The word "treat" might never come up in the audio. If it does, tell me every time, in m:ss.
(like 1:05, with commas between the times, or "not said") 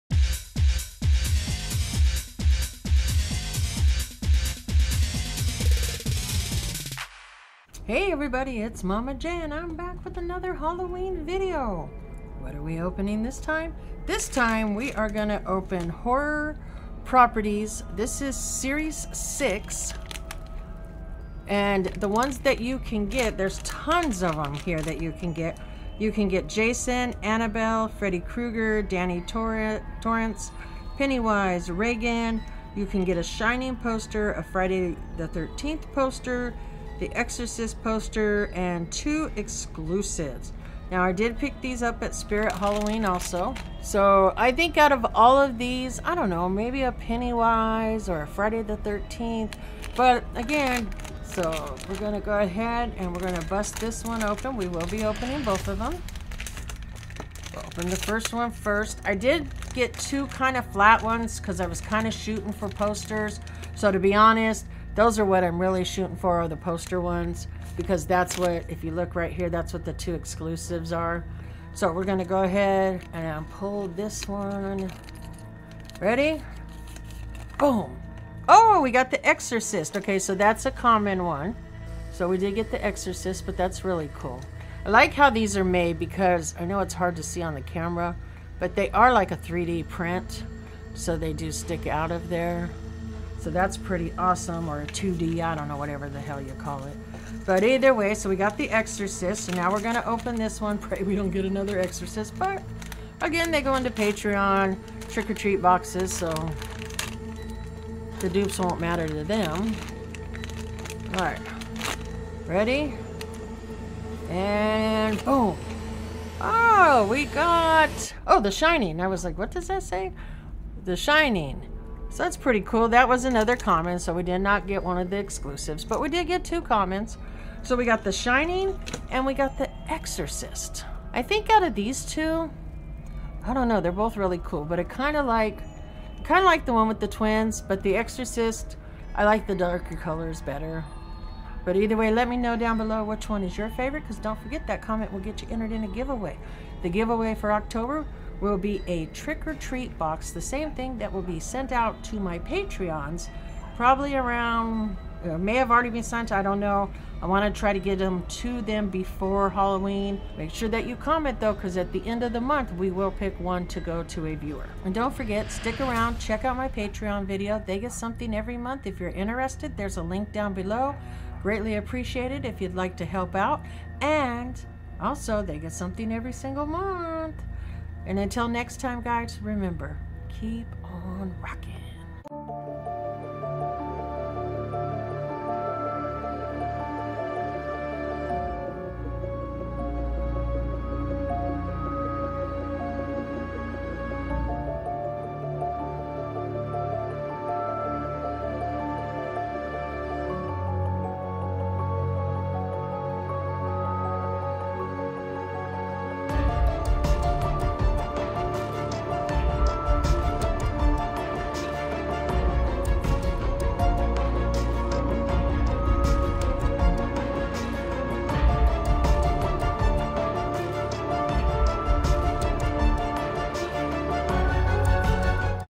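1:45, 2:29.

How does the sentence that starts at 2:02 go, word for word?
That was another common, so we did not get one of the exclusives, but we did get two commons.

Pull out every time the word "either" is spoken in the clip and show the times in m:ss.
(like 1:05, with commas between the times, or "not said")
1:37, 2:21.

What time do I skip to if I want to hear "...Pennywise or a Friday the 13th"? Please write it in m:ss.
0:46.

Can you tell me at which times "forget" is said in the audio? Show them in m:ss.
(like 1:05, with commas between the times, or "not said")
2:24, 2:45.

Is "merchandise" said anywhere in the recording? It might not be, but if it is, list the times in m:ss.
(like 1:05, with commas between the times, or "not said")
not said.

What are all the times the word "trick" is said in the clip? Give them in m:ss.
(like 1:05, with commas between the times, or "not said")
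1:45, 2:29.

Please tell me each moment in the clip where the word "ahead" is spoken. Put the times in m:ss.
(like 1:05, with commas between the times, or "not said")
0:52, 1:12.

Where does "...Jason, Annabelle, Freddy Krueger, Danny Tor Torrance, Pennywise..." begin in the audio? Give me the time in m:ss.
0:26.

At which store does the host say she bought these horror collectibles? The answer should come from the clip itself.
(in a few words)
Spirit Halloween.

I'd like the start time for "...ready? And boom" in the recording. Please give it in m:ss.
1:52.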